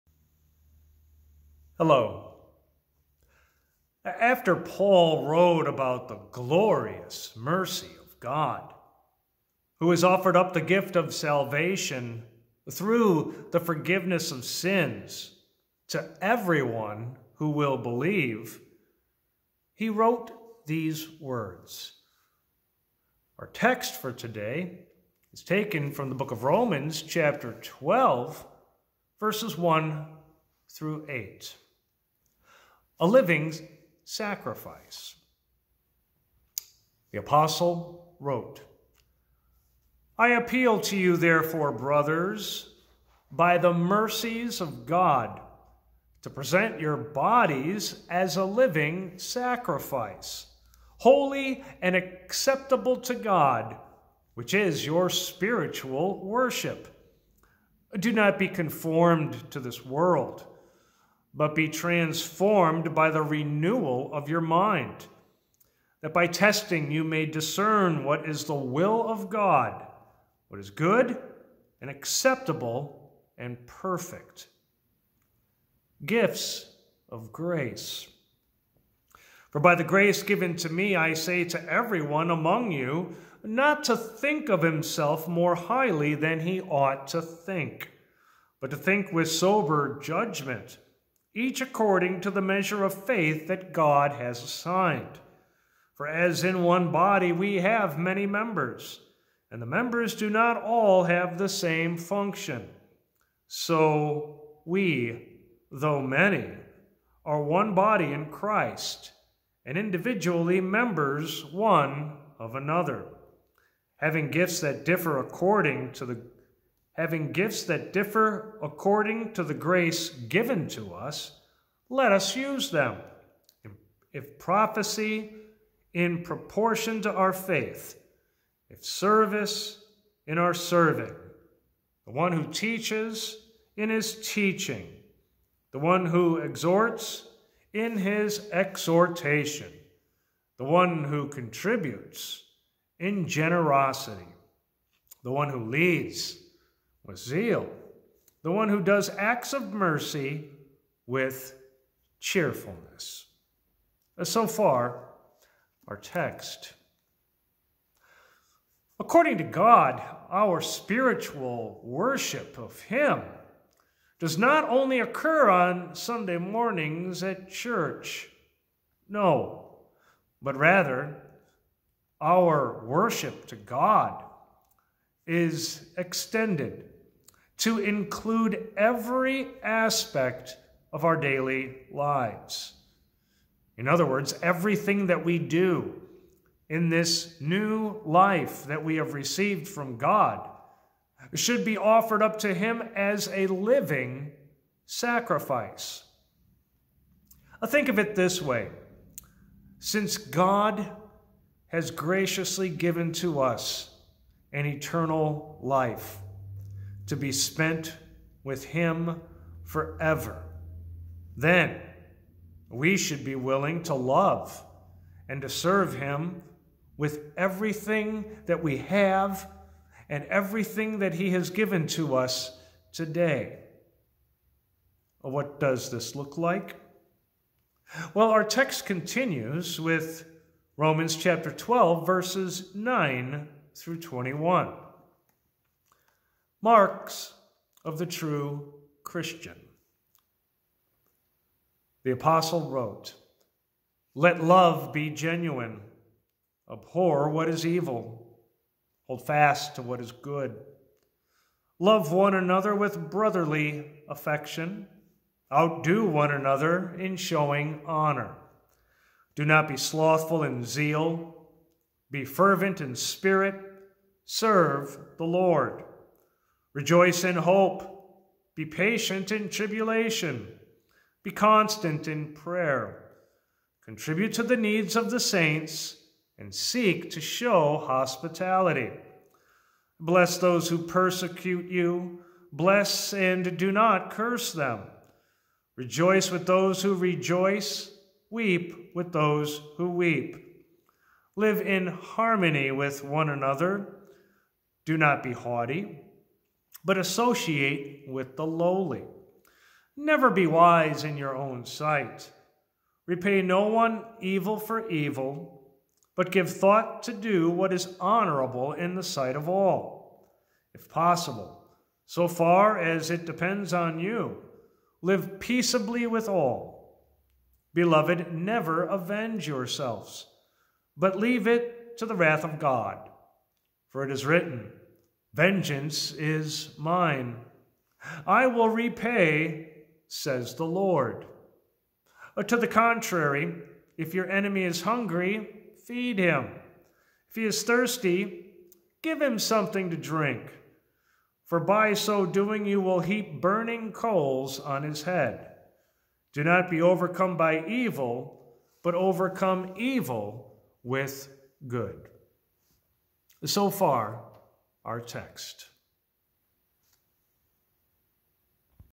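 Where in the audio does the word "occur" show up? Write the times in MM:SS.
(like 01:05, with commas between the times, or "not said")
02:44.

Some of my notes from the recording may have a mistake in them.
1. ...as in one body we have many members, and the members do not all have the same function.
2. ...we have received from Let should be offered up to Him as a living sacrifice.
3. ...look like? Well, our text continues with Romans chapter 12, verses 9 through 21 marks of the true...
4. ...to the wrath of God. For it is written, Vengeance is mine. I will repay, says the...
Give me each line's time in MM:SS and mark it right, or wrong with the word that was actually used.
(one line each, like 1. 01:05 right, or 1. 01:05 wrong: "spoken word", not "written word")
1. 01:36 right
2. 03:08 wrong: "God", not "Let"
3. 03:46 right
4. 05:21 right.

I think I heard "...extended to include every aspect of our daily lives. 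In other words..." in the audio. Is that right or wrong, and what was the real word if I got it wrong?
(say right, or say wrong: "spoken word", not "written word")
right.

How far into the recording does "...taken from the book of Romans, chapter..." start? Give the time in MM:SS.
00:25.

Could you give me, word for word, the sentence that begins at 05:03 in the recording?
Repay no one evil for evil, but give thought to do what is honorable in the sight of all.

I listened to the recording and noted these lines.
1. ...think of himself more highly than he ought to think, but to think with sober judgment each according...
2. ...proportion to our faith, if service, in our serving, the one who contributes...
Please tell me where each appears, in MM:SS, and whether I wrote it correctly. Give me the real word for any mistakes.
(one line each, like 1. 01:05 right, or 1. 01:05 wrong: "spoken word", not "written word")
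1. 01:23 right
2. 02:06 wrong: "teaches", not "contributes".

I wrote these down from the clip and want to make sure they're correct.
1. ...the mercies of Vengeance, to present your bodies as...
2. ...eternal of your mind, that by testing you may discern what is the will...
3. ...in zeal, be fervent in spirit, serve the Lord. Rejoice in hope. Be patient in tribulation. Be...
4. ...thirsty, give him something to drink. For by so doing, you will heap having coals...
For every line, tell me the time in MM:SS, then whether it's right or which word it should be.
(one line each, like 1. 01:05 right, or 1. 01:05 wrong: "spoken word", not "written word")
1. 00:43 wrong: "God", not "Vengeance"
2. 01:03 wrong: "renewal", not "eternal"
3. 04:20 right
4. 05:37 wrong: "burning", not "having".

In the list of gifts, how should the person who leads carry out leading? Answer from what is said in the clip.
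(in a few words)
with zeal.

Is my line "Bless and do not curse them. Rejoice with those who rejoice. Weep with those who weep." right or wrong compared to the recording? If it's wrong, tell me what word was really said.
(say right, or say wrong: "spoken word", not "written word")
right.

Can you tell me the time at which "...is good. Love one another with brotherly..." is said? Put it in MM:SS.
04:10.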